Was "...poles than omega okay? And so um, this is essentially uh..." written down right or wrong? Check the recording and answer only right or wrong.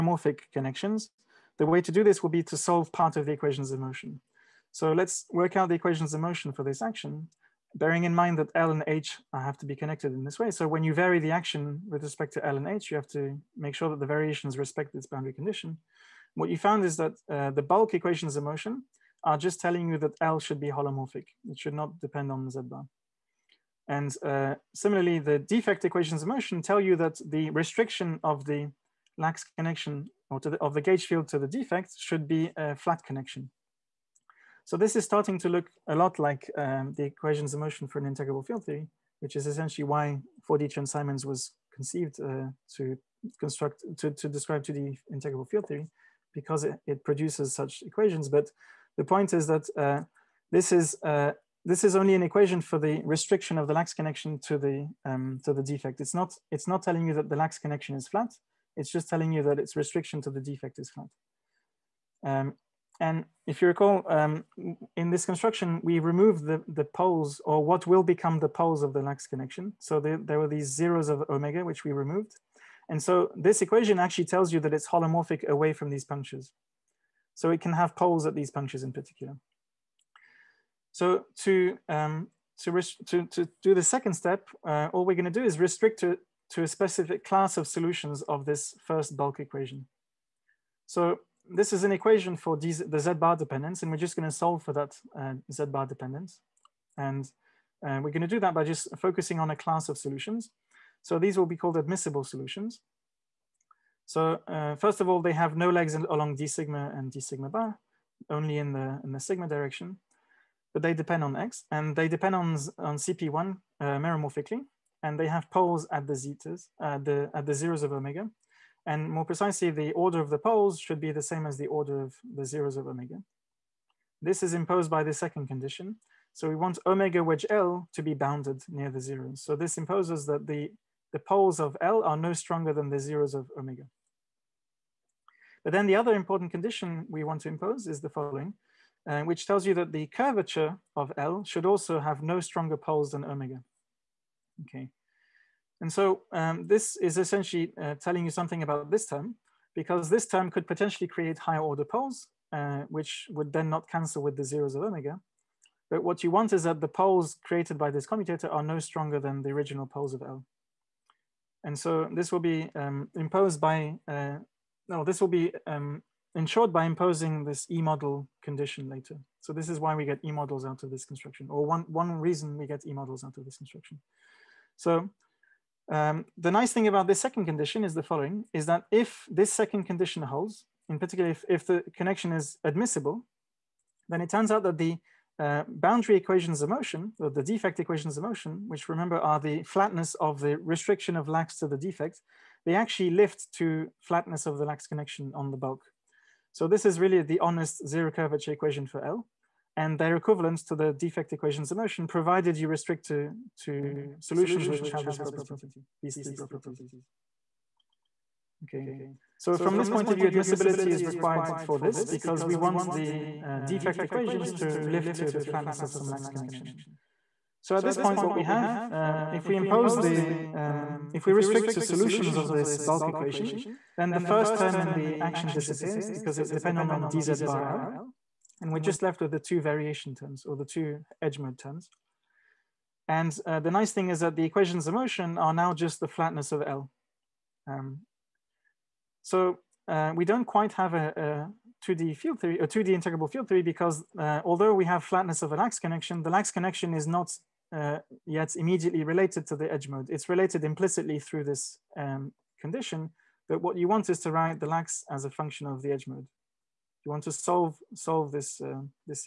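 right.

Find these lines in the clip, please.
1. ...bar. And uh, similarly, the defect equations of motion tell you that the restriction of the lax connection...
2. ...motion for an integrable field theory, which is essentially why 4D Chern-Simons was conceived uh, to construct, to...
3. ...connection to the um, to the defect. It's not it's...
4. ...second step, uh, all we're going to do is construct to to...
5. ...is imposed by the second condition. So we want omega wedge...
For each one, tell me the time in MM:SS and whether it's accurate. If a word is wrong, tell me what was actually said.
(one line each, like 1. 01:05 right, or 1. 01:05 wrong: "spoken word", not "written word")
1. 00:22 right
2. 00:37 right
3. 00:53 right
4. 01:23 wrong: "restrict", not "construct"
5. 02:04 right.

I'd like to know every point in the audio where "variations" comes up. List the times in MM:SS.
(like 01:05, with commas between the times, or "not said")
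00:14, 03:49.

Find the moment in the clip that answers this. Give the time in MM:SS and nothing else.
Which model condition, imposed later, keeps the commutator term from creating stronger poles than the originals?
02:47.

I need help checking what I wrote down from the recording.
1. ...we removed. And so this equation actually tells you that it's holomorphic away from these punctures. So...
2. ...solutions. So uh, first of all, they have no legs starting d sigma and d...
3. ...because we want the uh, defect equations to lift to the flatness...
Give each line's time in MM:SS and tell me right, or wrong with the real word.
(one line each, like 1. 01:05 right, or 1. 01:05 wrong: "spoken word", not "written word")
1. 01:11 right
2. 01:42 wrong: "along", not "starting"
3. 03:32 right.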